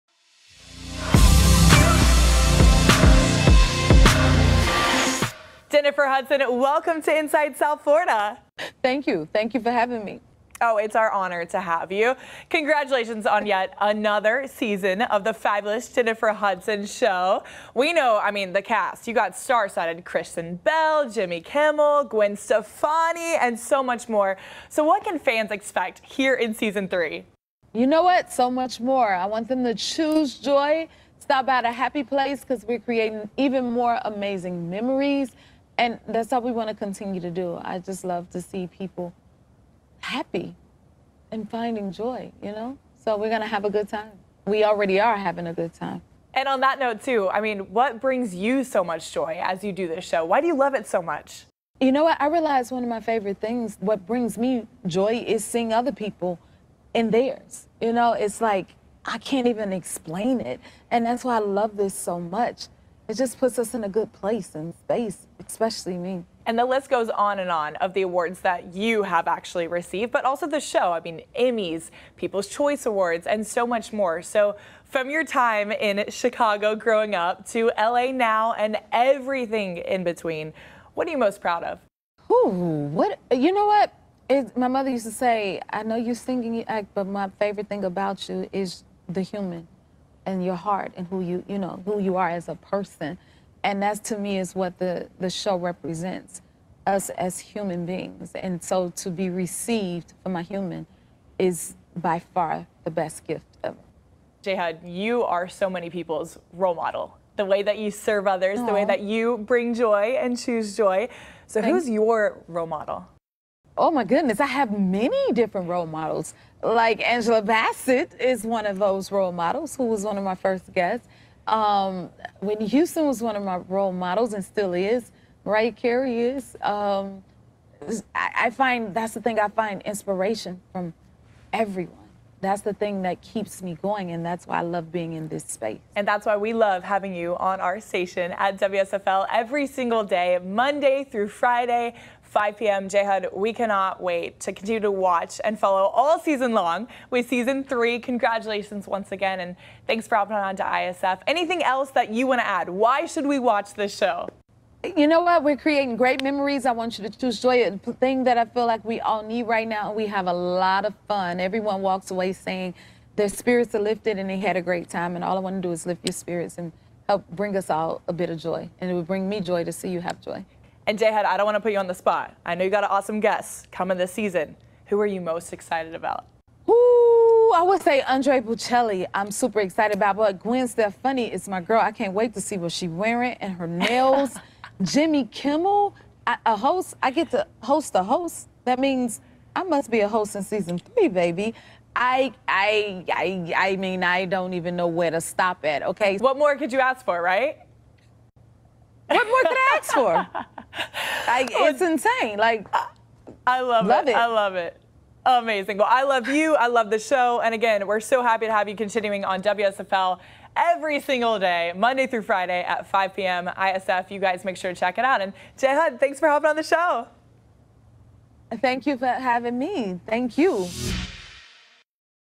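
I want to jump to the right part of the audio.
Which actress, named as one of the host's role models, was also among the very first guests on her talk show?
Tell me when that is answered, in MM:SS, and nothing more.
01:57.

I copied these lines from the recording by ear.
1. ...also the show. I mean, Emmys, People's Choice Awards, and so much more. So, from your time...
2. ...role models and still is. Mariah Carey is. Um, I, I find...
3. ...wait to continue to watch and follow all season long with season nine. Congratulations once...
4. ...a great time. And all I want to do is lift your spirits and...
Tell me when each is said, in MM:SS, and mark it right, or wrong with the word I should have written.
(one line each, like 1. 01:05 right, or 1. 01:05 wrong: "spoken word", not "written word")
1. 01:10 right
2. 02:03 right
3. 02:24 wrong: "three", not "nine"
4. 02:44 right.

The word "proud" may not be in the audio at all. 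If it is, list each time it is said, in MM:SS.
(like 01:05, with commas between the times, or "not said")
01:21.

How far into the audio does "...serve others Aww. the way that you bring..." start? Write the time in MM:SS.
01:47.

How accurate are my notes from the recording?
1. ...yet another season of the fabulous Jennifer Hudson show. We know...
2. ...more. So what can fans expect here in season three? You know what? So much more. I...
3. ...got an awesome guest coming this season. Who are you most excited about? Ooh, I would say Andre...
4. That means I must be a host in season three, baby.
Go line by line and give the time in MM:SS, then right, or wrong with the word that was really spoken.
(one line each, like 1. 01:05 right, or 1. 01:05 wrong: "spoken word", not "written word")
1. 00:13 right
2. 00:24 right
3. 02:52 right
4. 03:08 right.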